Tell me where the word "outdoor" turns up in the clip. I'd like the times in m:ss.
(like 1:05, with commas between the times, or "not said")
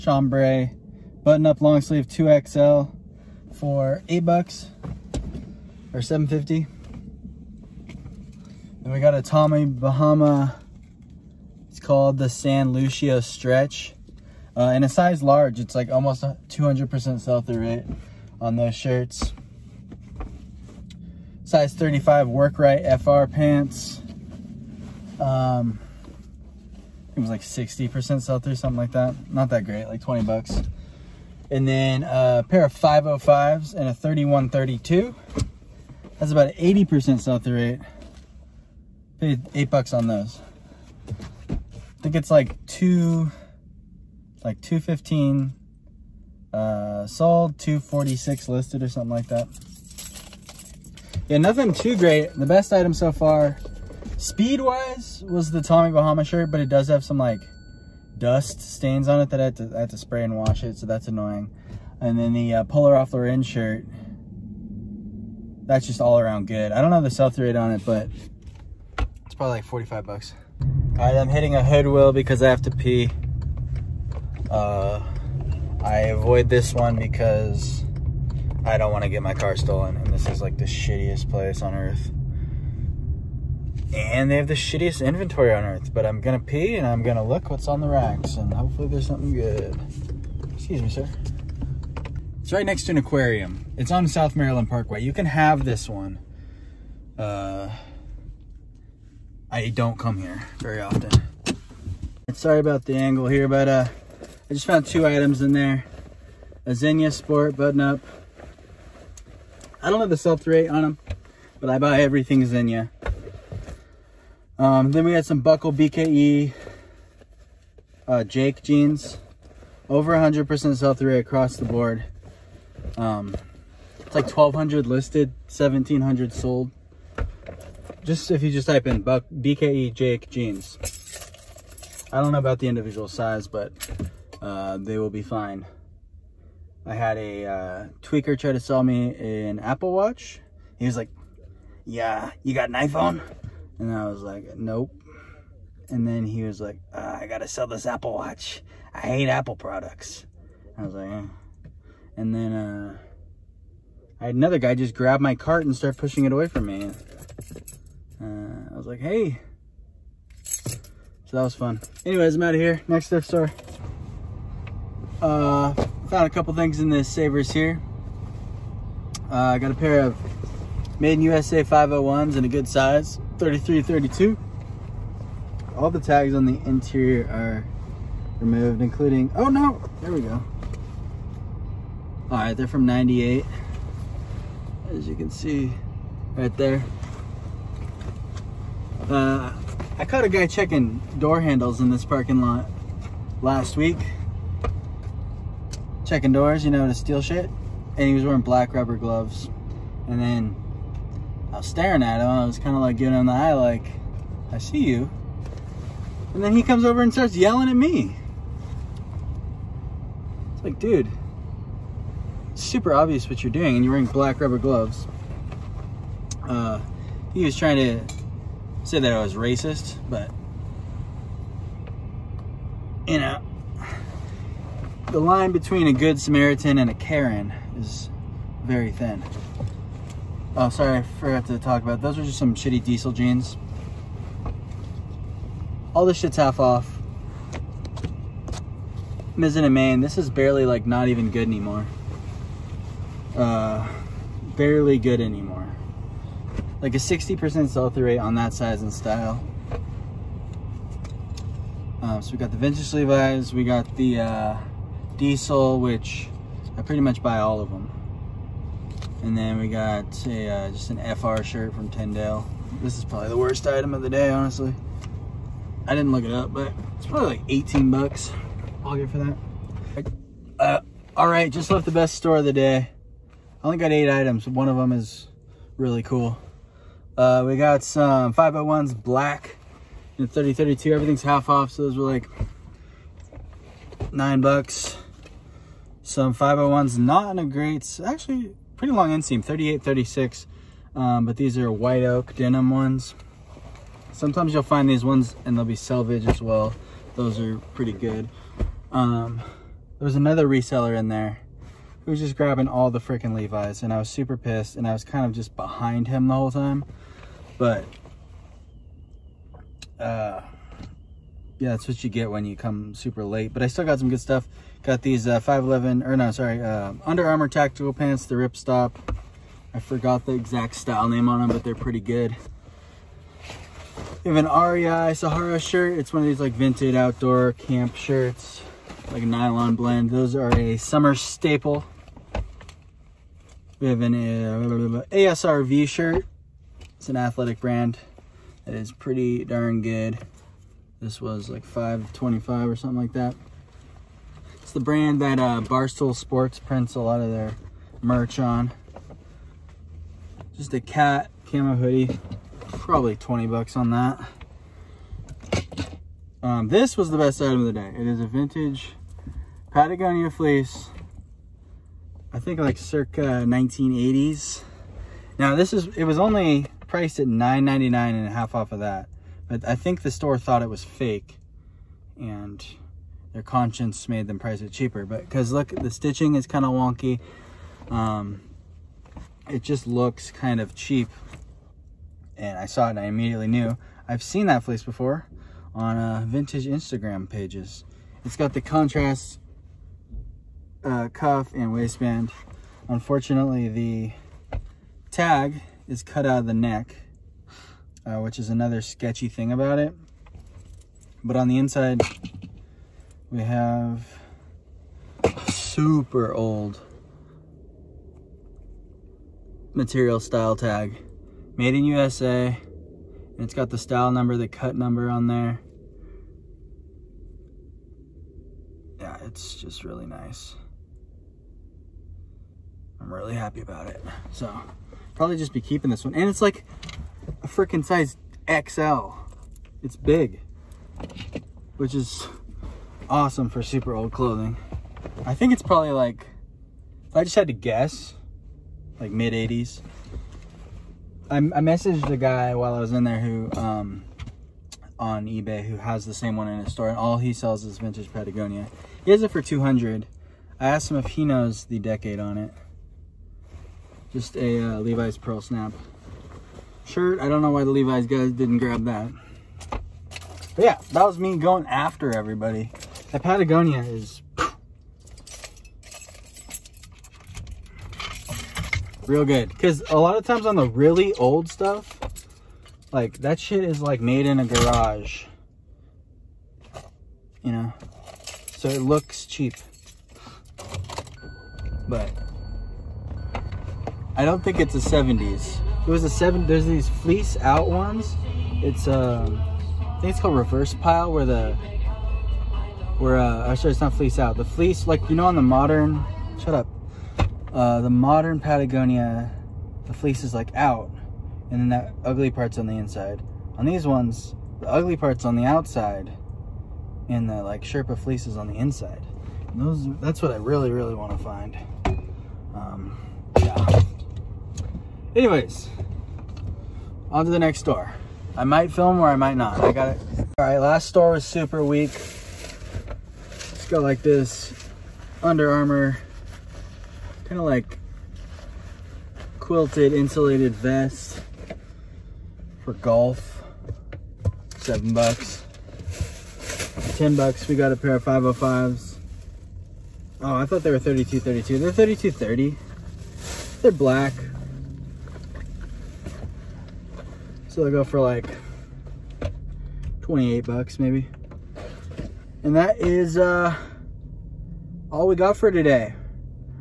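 5:26.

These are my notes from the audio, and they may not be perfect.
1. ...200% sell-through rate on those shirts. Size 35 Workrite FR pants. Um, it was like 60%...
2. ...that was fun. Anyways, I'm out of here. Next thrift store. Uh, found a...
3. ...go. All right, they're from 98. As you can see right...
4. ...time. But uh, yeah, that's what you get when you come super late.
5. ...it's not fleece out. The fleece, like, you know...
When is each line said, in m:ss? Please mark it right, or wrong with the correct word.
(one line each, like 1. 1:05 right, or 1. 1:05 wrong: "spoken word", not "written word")
1. 0:16 right
2. 2:41 right
3. 3:00 right
4. 5:06 right
5. 8:13 right.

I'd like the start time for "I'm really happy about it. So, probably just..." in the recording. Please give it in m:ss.
7:03.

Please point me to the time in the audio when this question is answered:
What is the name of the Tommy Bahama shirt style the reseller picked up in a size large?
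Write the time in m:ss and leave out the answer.
0:12.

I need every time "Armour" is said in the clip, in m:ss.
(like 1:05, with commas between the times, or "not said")
5:17, 8:45.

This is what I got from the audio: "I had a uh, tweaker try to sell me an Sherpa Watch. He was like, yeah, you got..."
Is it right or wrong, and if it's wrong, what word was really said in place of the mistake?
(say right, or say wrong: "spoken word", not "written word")
wrong: "Apple", not "Sherpa".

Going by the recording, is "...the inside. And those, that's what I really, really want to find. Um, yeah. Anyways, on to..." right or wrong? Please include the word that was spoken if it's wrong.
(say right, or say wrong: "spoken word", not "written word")
right.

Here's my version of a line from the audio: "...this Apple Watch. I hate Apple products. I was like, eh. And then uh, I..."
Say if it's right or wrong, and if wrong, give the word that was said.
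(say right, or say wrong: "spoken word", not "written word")
right.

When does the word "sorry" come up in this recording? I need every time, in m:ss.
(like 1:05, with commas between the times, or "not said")
1:42, 3:50, 5:16, 8:13.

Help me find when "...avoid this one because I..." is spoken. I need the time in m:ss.
1:16.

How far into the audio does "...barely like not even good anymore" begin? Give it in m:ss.
4:00.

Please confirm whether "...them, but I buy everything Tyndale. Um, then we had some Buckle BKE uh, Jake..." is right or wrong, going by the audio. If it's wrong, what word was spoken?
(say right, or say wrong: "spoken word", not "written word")
wrong: "Zinnia", not "Tyndale".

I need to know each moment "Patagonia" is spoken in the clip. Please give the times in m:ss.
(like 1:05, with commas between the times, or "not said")
5:59, 7:28, 7:43, 8:18.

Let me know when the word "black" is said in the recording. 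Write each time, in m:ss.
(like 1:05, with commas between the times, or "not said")
3:18, 3:34, 4:38, 9:03.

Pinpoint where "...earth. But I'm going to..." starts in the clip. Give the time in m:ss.
1:25.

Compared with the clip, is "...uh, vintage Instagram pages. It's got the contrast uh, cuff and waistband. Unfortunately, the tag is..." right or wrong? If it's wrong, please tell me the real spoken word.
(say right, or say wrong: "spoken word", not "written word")
right.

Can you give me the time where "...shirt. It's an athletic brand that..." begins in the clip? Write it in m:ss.
5:35.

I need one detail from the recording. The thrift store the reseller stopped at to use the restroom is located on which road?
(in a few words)
South Maryland Parkway.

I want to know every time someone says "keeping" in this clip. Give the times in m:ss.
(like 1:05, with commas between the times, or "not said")
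7:05.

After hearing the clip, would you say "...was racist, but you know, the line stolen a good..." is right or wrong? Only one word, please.
wrong.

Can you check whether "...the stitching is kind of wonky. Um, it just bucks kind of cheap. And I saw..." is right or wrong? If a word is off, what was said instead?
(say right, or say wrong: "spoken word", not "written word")
wrong: "looks", not "bucks".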